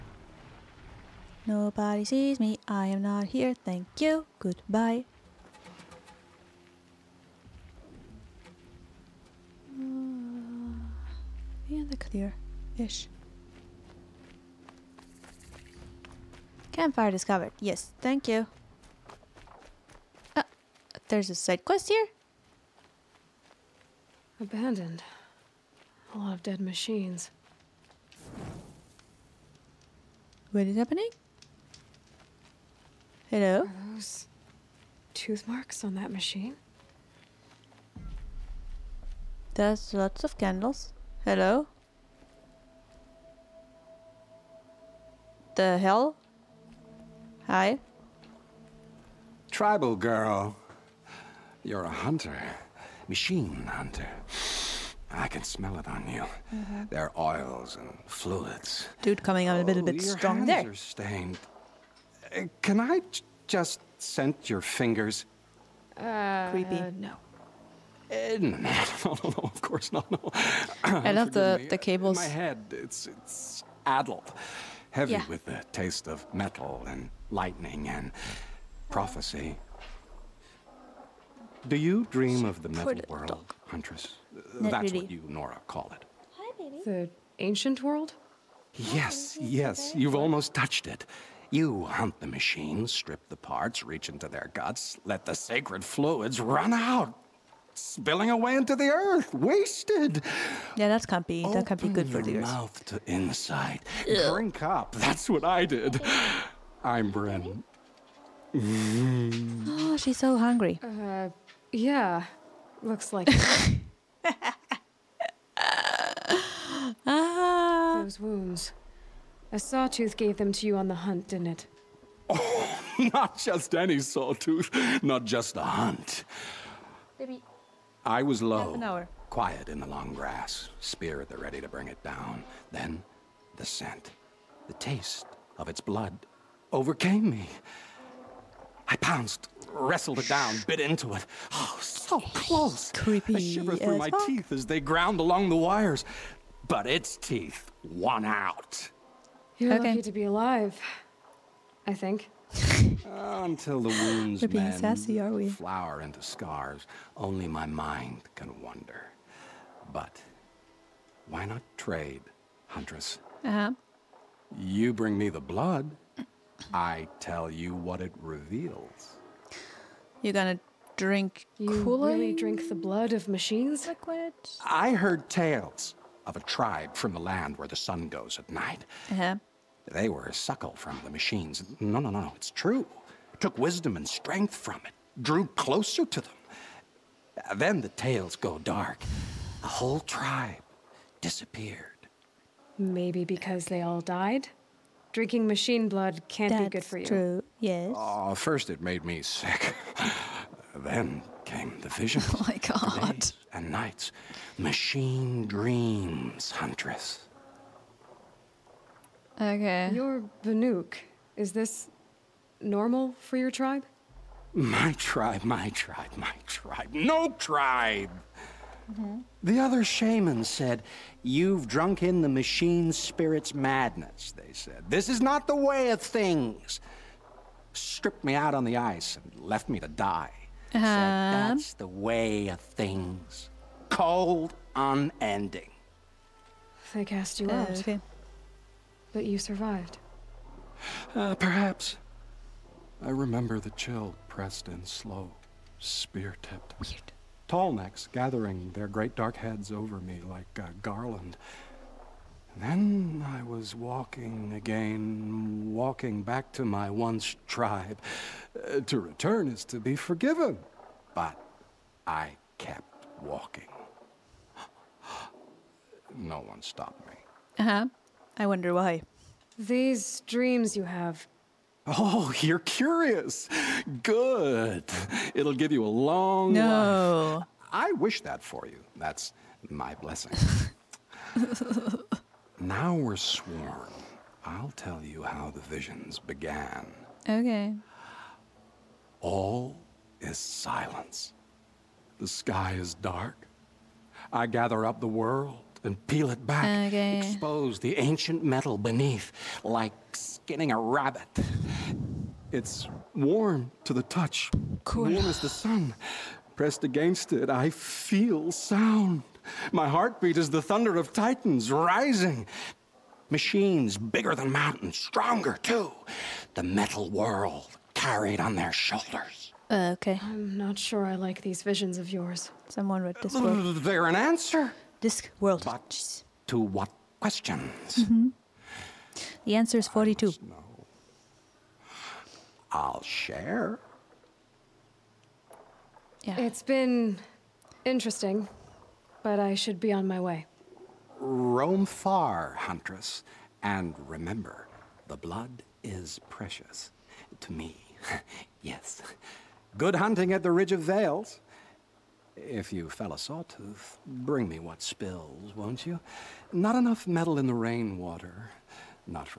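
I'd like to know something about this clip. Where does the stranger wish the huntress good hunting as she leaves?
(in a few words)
Ridge of Vales.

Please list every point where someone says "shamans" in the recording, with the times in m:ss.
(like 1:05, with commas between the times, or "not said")
3:39.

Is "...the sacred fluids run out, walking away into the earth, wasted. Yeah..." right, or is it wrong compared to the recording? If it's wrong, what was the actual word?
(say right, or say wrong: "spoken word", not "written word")
wrong: "spilling", not "walking".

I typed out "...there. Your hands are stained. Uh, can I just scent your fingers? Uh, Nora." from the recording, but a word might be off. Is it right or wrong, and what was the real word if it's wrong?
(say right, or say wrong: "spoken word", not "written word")
wrong: "Creepy", not "Nora".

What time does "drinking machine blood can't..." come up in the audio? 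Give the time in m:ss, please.
3:15.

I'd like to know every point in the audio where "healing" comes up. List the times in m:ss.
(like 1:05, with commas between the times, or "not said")
not said.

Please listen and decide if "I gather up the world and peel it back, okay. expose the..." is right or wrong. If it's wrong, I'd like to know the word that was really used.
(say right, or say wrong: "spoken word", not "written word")
right.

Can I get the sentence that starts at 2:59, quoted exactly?
They were a suckle from the machines.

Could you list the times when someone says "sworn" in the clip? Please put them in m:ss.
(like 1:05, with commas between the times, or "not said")
4:43.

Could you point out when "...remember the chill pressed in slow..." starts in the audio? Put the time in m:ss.
4:03.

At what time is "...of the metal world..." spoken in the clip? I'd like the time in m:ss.
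1:22.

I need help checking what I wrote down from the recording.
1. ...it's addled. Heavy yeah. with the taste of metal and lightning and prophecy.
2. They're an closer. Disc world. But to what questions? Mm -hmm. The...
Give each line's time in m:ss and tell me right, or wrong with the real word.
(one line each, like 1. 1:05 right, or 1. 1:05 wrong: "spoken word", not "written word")
1. 1:13 right
2. 5:23 wrong: "answer", not "closer".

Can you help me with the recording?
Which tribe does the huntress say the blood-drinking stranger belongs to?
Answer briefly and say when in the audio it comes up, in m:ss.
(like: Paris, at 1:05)
Banuk, at 3:30.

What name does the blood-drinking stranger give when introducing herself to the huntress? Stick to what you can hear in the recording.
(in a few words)
Brin.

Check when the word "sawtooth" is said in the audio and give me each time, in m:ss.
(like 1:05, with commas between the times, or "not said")
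1:59, 2:03, 5:53.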